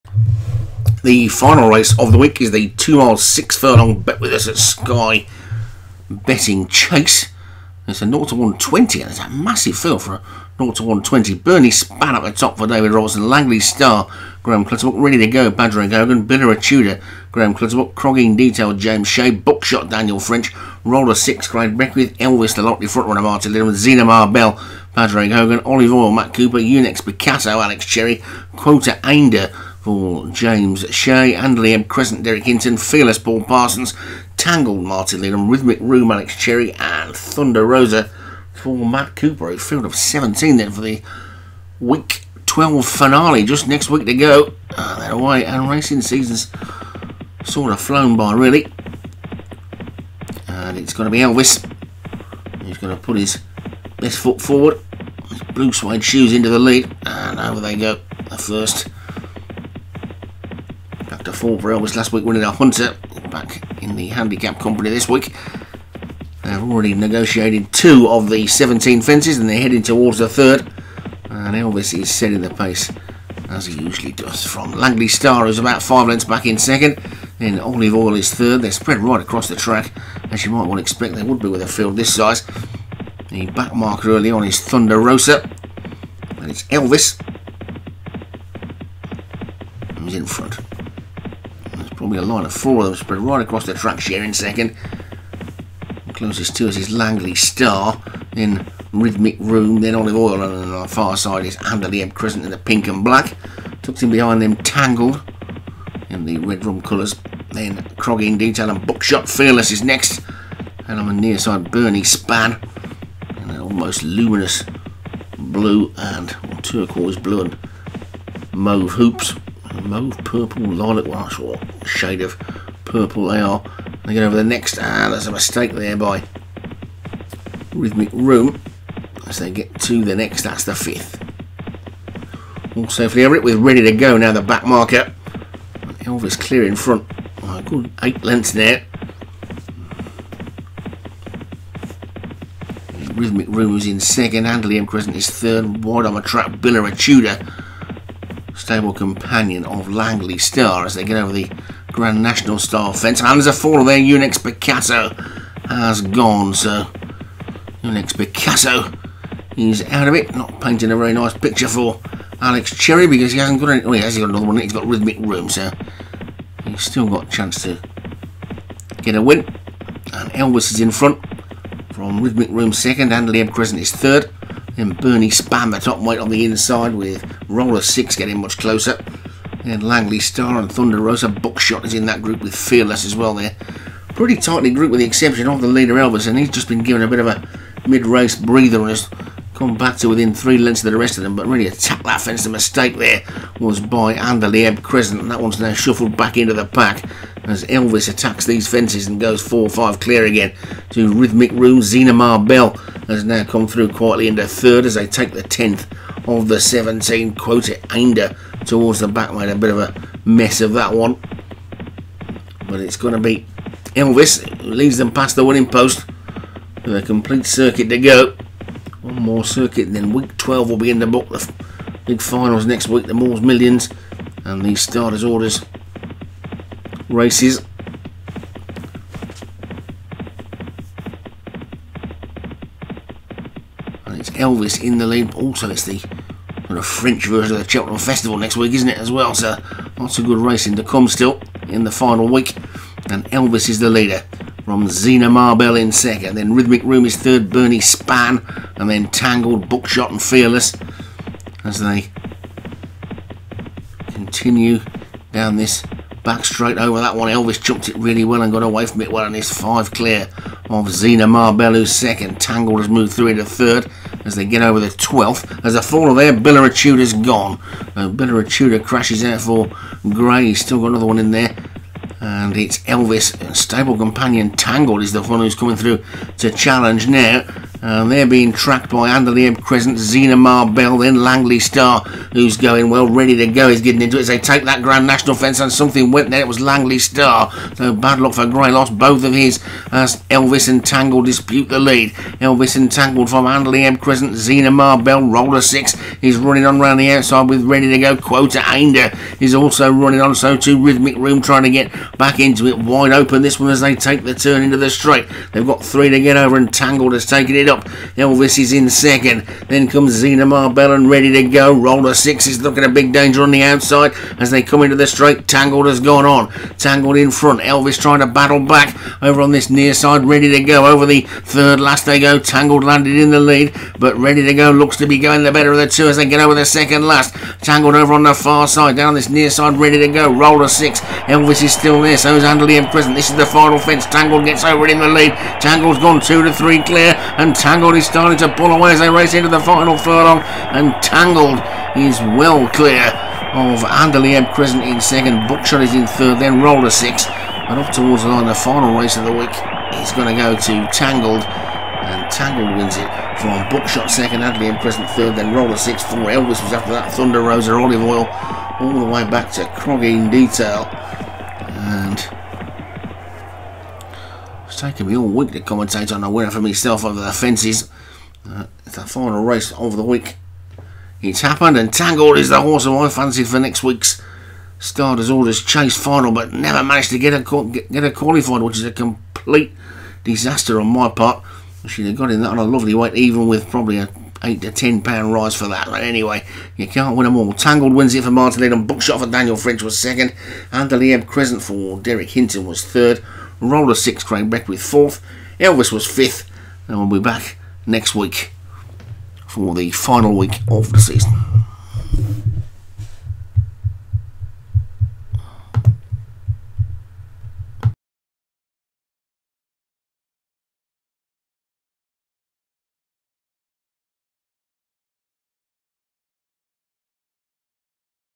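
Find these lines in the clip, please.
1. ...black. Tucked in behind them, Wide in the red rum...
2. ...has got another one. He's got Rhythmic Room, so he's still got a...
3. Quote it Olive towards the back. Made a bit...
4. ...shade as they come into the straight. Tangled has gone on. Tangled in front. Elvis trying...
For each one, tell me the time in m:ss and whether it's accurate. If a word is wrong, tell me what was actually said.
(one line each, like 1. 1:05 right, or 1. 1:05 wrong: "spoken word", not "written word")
1. 1:43 wrong: "Tangled", not "Wide"
2. 2:44 right
3. 3:27 wrong: "Ainder", not "Olive"
4. 5:13 wrong: "outside", not "shade".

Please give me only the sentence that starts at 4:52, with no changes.
Elvis Entangled from Andalieb Crescent, Zena Marbell, Roller 6.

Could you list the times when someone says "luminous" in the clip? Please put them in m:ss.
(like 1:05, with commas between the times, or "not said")
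1:54.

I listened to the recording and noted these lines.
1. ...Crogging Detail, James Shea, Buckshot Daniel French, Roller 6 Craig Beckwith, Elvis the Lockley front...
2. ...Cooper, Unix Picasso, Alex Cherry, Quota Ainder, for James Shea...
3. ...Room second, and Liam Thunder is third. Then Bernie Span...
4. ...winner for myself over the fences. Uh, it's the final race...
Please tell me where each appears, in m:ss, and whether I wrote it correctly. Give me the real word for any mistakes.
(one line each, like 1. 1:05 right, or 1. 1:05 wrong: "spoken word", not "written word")
1. 0:17 right
2. 0:26 right
3. 2:52 wrong: "Crescent", not "Thunder"
4. 6:06 right.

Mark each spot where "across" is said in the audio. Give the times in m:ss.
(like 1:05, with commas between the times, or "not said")
1:19, 1:33.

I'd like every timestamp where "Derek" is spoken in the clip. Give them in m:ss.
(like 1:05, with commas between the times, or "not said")
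0:32, 6:31.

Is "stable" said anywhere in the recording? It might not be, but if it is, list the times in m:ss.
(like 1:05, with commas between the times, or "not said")
2:28, 4:33.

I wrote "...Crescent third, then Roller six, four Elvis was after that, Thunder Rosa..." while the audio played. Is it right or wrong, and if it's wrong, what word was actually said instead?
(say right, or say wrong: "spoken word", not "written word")
right.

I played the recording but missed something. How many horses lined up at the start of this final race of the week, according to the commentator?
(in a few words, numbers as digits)
17.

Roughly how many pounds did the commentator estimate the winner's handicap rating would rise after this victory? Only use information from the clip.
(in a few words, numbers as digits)
8 to 10.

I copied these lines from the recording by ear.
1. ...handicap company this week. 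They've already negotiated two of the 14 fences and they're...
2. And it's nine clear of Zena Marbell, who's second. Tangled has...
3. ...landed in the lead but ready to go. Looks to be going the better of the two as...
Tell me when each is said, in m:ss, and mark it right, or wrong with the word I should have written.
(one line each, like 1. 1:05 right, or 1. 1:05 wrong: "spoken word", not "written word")
1. 1:04 wrong: "17", not "14"
2. 4:19 wrong: "five", not "nine"
3. 5:22 right.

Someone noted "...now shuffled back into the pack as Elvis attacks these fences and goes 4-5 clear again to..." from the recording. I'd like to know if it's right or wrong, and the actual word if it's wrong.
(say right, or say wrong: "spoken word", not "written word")
right.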